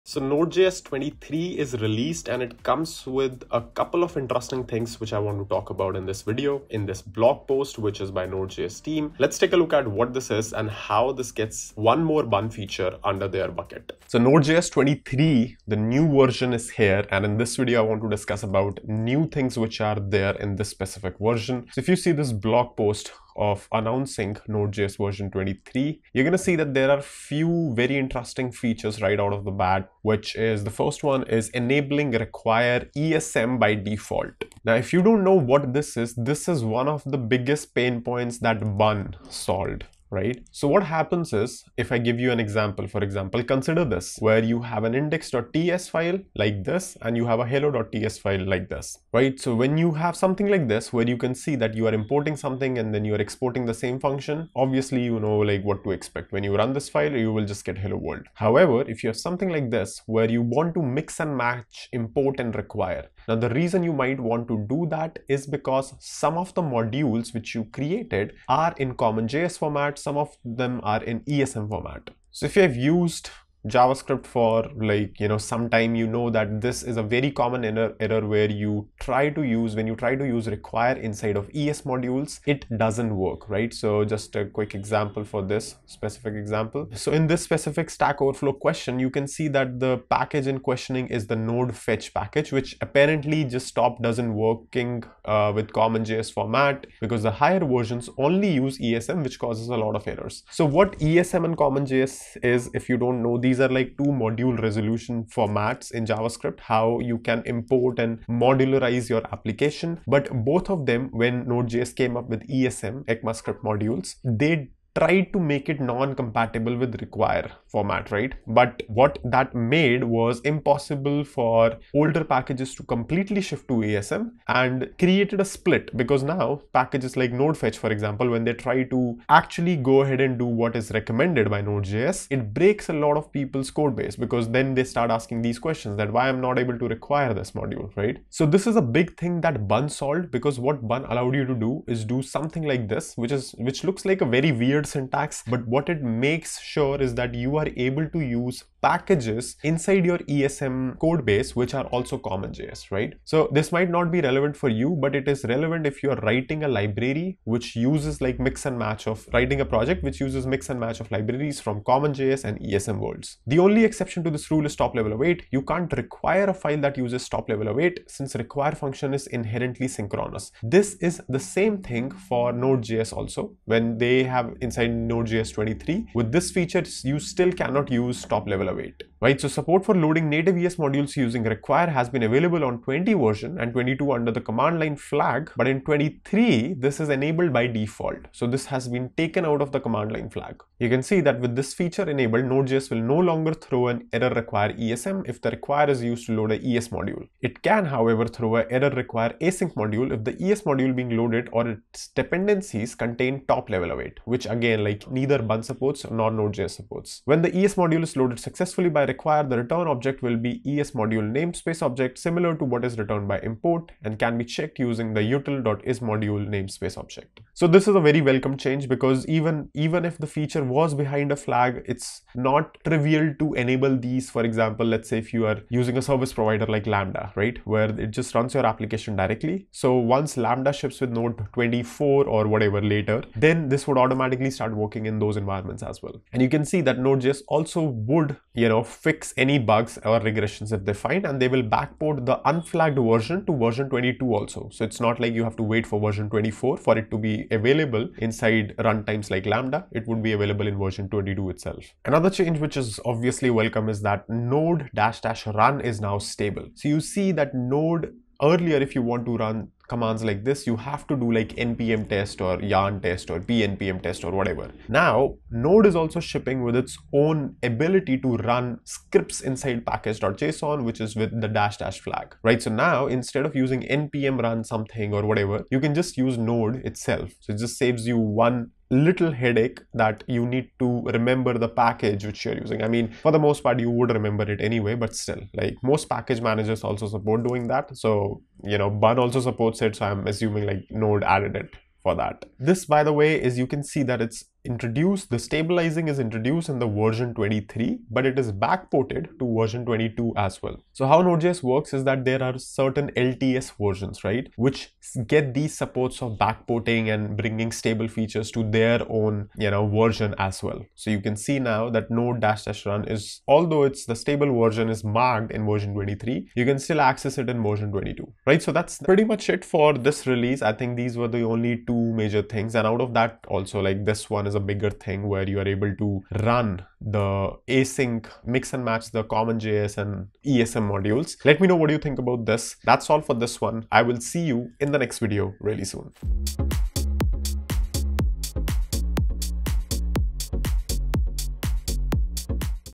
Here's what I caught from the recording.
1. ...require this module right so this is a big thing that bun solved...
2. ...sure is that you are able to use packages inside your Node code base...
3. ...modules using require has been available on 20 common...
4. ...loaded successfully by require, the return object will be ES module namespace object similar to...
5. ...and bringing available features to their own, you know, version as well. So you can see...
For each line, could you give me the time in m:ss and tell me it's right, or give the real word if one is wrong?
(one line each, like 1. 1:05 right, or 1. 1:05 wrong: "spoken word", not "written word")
1. 2:16 right
2. 2:26 wrong: "ESM", not "Node"
3. 3:00 wrong: "version", not "common"
4. 3:28 right
5. 5:07 wrong: "stable", not "available".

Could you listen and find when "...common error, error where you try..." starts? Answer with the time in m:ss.
1:17.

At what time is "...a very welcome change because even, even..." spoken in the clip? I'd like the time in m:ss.
3:38.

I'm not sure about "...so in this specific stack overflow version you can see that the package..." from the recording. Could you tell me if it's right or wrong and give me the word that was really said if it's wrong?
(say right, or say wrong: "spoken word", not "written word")
wrong: "question", not "version".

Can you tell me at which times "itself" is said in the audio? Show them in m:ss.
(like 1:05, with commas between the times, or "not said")
4:11, 4:36.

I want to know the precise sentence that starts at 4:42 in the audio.
I mean, for the most part, you would remember it anyway, but still, like most package managers also support doing that.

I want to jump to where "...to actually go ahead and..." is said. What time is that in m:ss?
2:08.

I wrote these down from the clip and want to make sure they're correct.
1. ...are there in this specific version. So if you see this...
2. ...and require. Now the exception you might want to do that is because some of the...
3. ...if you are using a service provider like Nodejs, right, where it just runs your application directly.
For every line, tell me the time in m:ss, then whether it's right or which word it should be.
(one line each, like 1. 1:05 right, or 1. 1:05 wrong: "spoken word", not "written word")
1. 0:19 right
2. 1:02 wrong: "reason", not "exception"
3. 3:45 wrong: "Lambda", not "Nodejs".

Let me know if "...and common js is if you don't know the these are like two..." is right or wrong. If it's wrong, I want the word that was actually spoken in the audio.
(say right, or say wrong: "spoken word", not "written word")
right.